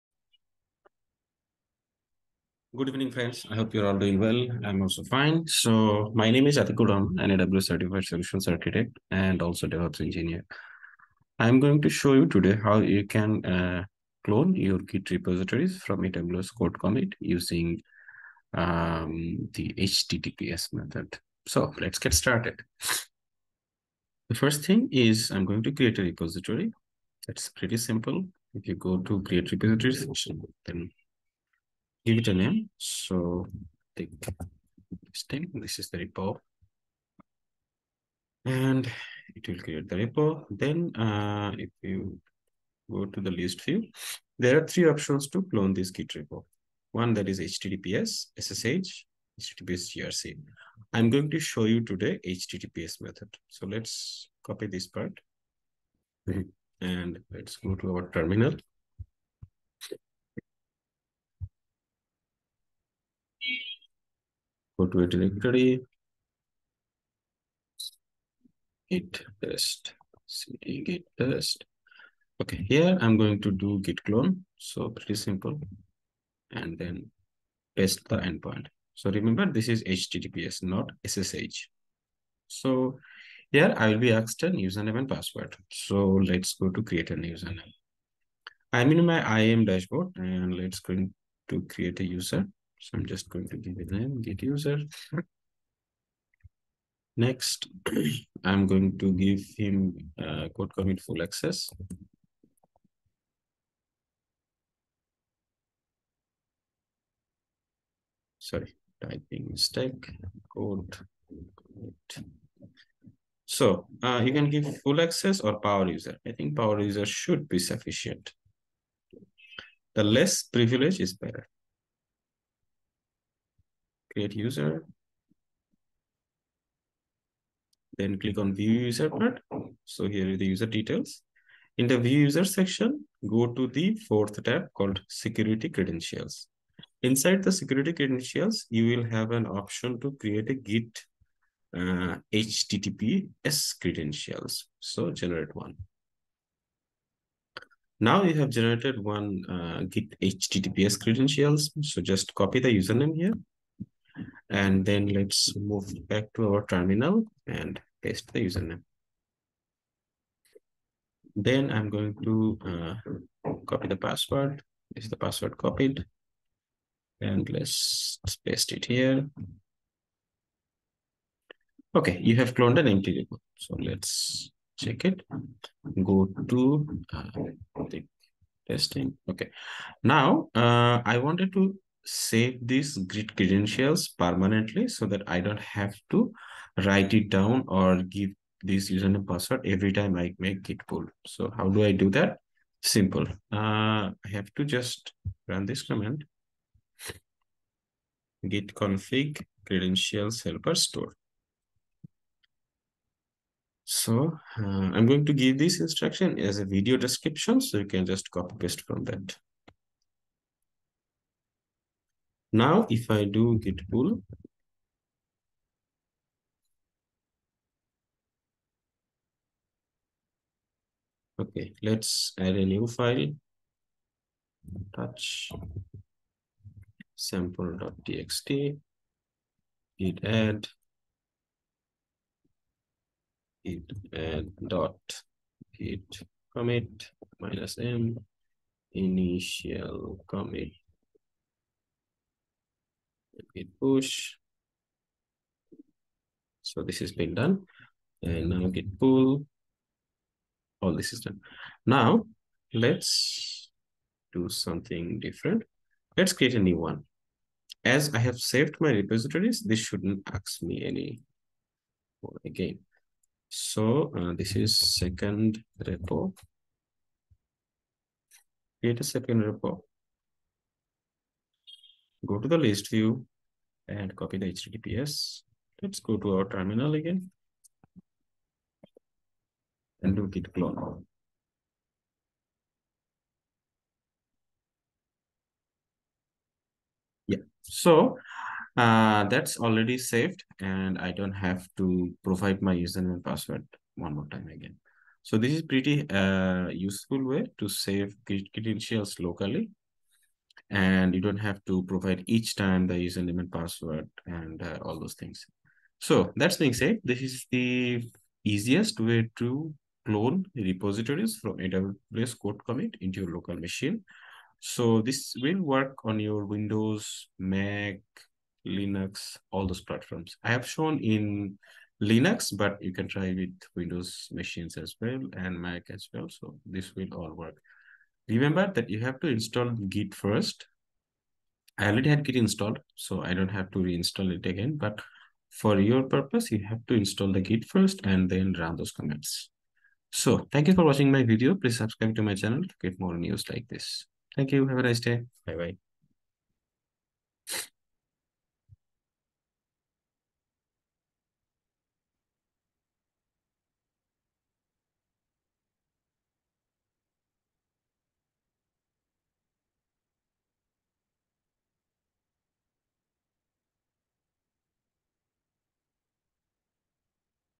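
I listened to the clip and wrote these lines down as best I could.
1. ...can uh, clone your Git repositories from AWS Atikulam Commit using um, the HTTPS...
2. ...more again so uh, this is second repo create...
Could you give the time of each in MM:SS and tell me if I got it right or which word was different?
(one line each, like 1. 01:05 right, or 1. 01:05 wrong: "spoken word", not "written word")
1. 00:13 wrong: "Code", not "Atikulam"
2. 04:22 right.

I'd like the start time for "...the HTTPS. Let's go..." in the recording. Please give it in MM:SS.
04:34.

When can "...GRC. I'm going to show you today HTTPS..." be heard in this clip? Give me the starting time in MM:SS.
00:49.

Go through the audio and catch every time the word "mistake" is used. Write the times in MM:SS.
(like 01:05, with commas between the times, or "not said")
01:49.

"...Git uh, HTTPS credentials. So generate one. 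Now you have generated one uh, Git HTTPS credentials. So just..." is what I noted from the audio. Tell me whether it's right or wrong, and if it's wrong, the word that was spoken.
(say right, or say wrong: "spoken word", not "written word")
right.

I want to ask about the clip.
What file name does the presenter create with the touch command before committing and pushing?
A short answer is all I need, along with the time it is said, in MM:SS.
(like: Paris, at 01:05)
sample.txt, at 03:47.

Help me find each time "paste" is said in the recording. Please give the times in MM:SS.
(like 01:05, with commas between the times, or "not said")
02:38, 02:48, 03:28.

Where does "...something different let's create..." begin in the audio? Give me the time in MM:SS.
04:14.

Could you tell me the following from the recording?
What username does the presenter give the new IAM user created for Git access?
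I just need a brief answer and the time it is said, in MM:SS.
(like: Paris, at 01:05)
get user, at 01:34.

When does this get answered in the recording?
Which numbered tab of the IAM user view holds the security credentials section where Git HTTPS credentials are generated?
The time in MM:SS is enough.
02:14.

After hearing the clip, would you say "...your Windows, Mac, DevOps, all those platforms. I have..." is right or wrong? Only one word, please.
wrong.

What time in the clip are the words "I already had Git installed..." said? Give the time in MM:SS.
05:31.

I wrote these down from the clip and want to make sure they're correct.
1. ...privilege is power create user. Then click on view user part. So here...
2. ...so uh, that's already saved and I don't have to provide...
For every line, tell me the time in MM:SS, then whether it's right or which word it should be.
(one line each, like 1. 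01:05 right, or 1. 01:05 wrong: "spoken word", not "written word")
1. 02:00 wrong: "better", not "power"
2. 04:47 right.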